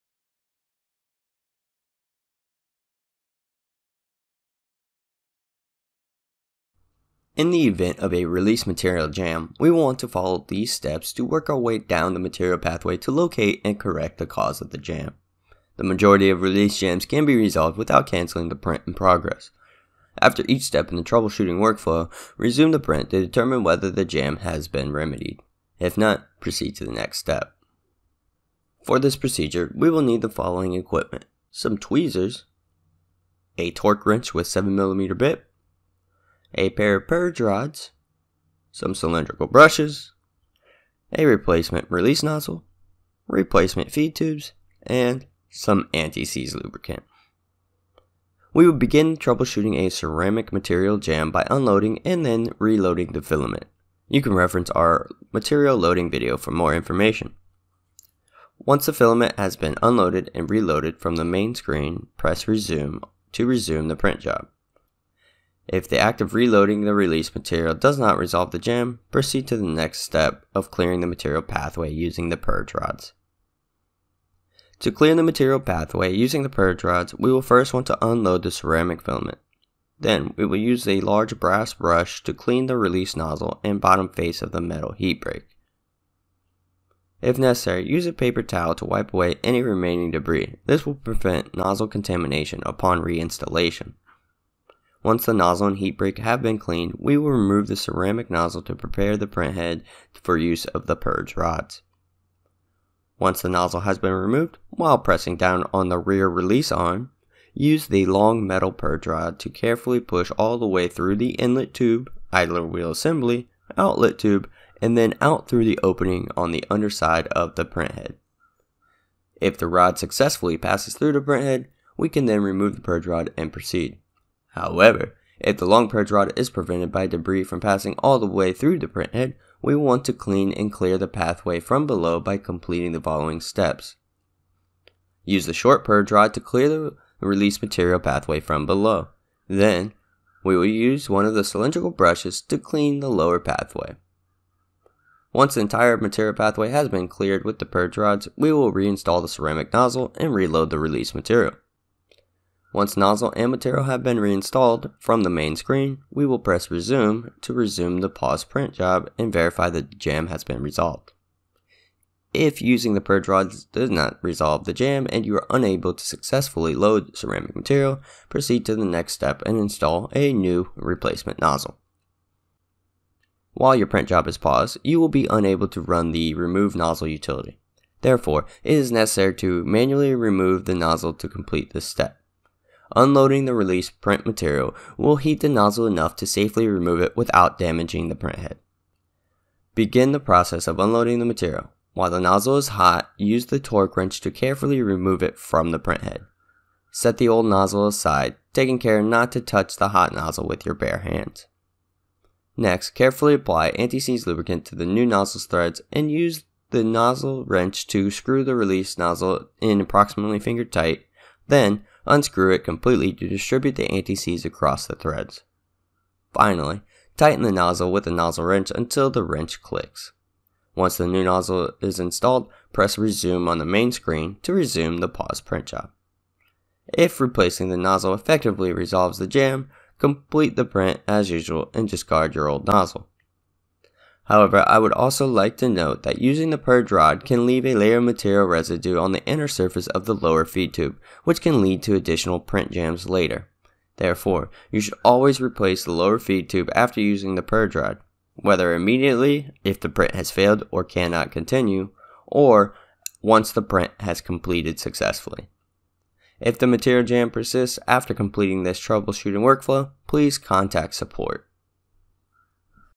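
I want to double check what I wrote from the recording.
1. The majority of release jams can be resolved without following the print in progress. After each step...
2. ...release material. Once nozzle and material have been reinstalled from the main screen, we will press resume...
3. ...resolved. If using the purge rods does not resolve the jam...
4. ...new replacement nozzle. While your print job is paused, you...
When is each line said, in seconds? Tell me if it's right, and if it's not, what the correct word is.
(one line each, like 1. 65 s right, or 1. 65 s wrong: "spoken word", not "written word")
1. 15 s wrong: "canceling", not "following"
2. 150 s right
3. 160 s right
4. 170 s right.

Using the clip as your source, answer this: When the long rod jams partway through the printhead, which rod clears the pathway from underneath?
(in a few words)
Short purge rod.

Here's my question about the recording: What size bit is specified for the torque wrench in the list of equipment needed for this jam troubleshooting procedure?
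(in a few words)
7mm.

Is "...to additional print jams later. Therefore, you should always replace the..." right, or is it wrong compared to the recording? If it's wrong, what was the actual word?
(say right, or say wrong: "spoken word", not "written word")
right.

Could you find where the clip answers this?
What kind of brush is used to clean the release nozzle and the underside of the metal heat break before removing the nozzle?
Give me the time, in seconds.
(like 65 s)
81 s.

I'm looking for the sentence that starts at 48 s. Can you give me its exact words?
We would begin troubleshooting a ceramic material jam by unloading and then reloading the filament.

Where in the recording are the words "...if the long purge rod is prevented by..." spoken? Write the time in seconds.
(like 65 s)
125 s.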